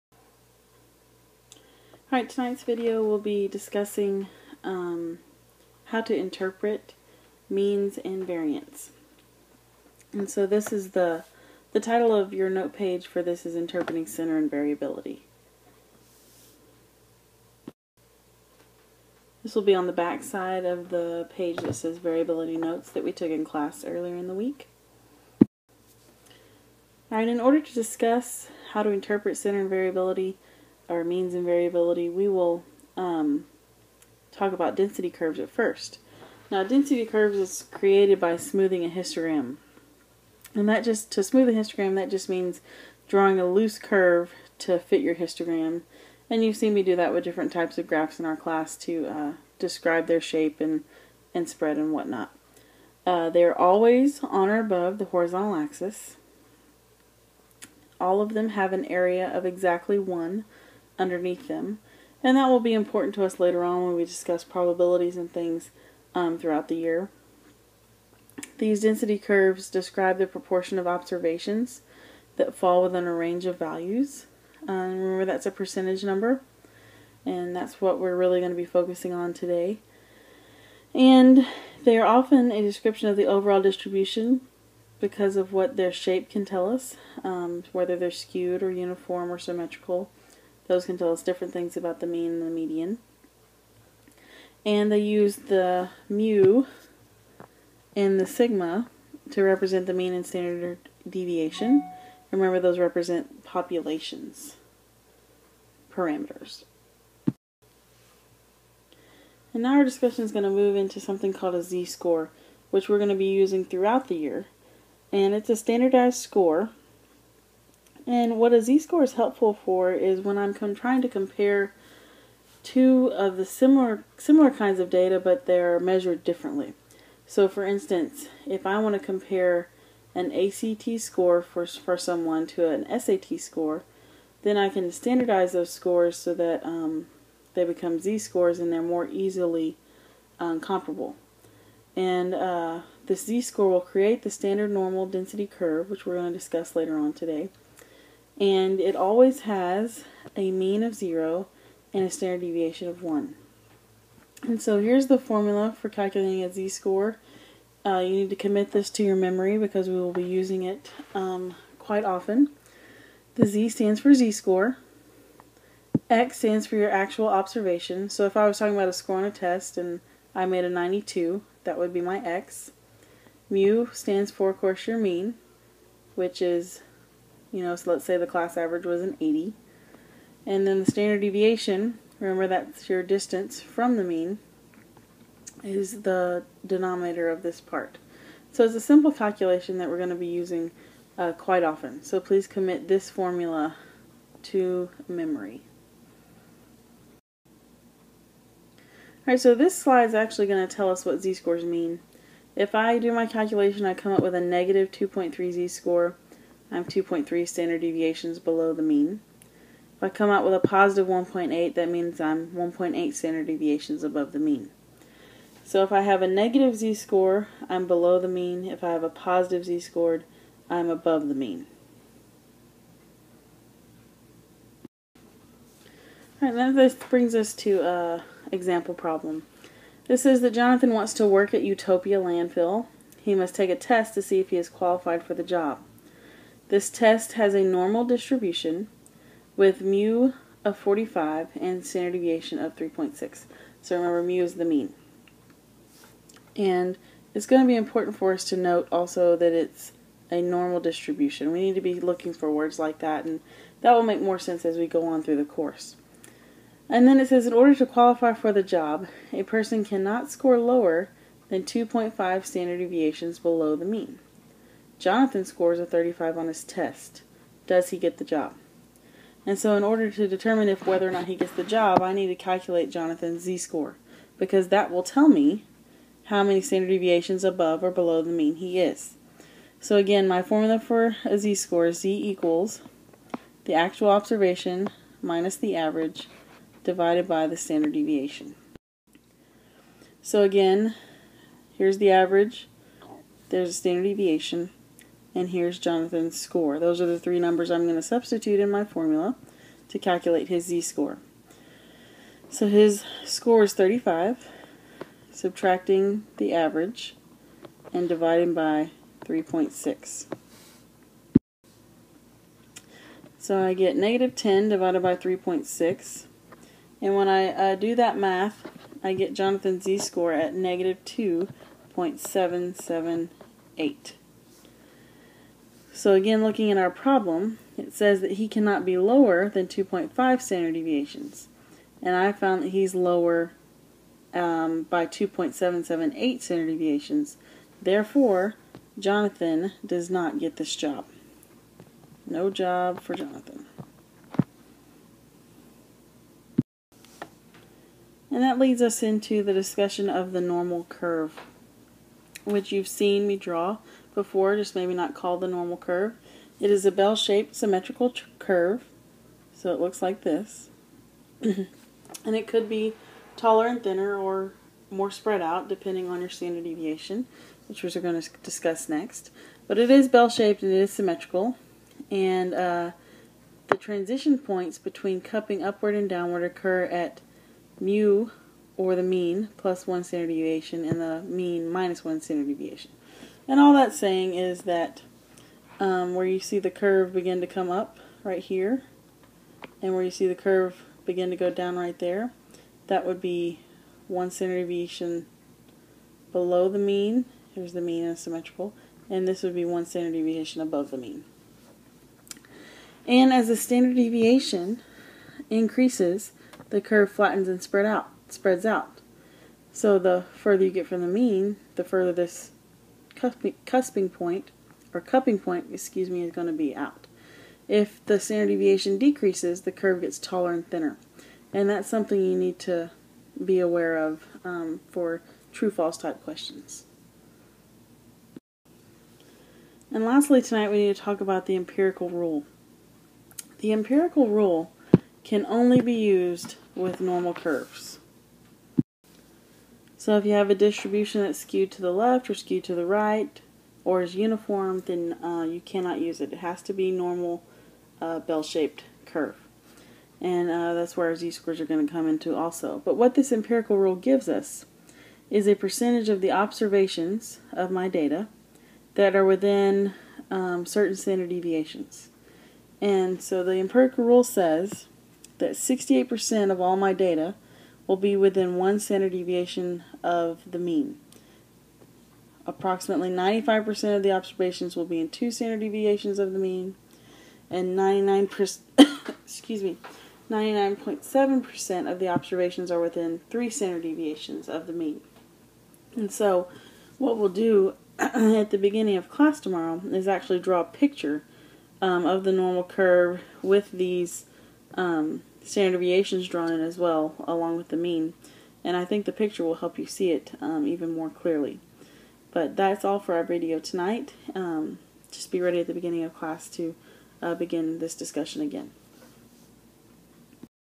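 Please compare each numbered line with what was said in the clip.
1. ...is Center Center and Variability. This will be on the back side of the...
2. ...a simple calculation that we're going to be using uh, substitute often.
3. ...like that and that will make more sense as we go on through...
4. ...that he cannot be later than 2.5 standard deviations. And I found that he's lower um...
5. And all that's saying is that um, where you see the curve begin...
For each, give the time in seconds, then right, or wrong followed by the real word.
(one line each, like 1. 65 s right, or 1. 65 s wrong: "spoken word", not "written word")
1. 13 s wrong: "Interpreting", not "Center"
2. 188 s wrong: "quite", not "substitute"
3. 252 s right
4. 328 s wrong: "lower", not "later"
5. 383 s right.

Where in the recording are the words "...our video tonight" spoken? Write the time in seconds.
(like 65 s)
503 s.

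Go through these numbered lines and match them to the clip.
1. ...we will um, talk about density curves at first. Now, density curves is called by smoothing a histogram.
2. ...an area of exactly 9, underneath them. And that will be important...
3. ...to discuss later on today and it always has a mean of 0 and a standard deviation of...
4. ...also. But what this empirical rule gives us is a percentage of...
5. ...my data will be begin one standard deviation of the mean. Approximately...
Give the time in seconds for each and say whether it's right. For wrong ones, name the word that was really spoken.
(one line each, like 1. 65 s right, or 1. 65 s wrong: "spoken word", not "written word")
1. 32 s wrong: "created", not "called"
2. 58 s wrong: "1", not "9"
3. 146 s right
4. 452 s right
5. 466 s wrong: "within", not "begin".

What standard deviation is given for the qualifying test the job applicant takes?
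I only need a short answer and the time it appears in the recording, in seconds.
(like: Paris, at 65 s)
3.6, at 241 s.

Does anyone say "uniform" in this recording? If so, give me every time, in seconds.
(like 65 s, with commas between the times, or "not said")
88 s, 444 s.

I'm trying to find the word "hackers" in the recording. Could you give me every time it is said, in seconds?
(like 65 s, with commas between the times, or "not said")
not said.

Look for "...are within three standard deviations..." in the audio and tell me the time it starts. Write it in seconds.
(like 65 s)
482 s.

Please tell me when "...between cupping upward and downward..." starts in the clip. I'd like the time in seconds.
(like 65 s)
374 s.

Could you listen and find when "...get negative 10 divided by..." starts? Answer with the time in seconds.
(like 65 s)
313 s.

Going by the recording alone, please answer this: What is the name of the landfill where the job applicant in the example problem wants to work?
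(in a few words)
Utopia Landfill.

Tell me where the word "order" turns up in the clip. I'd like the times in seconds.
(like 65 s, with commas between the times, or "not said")
27 s, 257 s, 269 s.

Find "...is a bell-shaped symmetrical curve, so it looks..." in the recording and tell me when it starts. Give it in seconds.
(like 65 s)
356 s.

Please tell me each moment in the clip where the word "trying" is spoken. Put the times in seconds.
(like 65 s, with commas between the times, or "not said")
120 s.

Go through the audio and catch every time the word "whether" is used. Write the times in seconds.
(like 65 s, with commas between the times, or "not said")
87 s, 270 s.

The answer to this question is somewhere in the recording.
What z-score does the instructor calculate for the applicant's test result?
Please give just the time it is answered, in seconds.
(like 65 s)
320 s.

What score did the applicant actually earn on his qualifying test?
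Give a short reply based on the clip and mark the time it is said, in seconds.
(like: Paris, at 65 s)
35, at 265 s.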